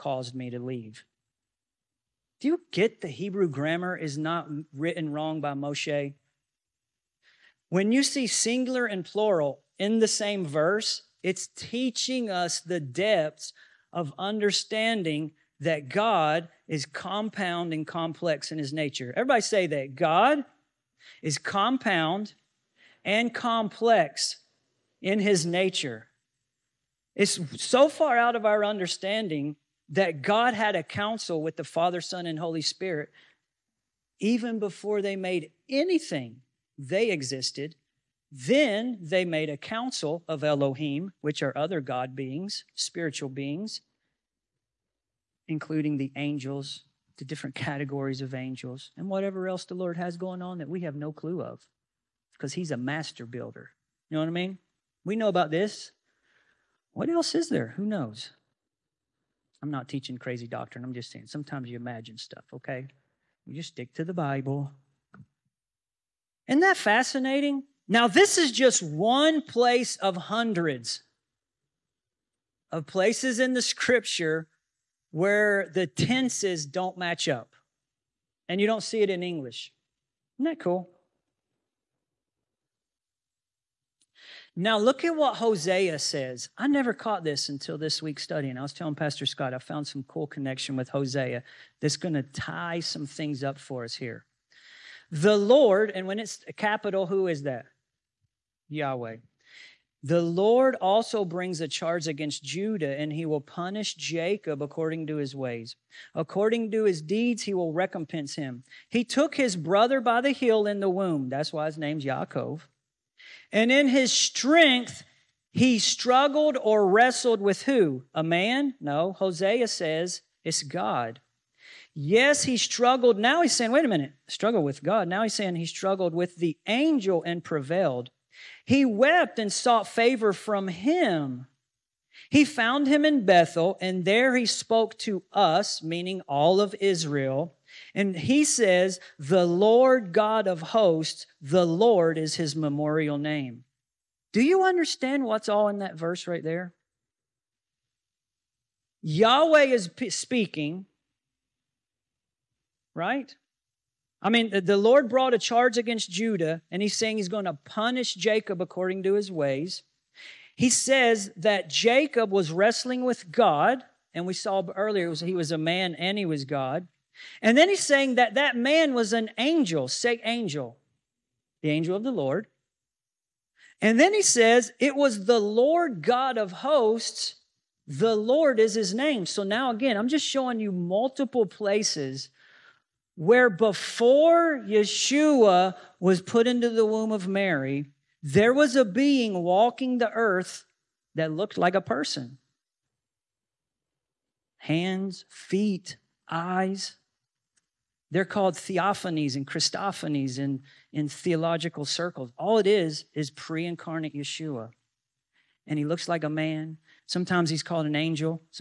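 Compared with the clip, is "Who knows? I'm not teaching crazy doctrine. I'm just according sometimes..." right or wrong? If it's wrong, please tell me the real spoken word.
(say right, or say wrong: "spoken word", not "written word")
wrong: "saying", not "according".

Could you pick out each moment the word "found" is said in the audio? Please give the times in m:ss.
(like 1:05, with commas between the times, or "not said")
1:29, 2:12.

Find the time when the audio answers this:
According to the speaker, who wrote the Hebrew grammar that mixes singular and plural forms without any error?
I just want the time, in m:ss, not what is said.
0:05.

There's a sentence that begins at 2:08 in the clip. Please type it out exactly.
He wept and sought favor from him.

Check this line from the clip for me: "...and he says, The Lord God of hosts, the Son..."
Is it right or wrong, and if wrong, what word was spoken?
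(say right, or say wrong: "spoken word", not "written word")
wrong: "Lord", not "Son".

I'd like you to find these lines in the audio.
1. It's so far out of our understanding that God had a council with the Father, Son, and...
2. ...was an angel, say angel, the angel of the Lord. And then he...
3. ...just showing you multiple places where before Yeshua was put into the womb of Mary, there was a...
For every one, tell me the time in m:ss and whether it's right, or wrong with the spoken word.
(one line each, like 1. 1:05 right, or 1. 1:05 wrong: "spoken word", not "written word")
1. 0:27 right
2. 2:48 right
3. 3:00 right.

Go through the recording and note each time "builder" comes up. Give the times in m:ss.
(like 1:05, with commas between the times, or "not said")
0:53.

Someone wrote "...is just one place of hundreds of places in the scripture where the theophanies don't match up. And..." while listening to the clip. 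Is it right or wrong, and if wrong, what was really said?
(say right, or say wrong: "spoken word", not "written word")
wrong: "tenses", not "theophanies".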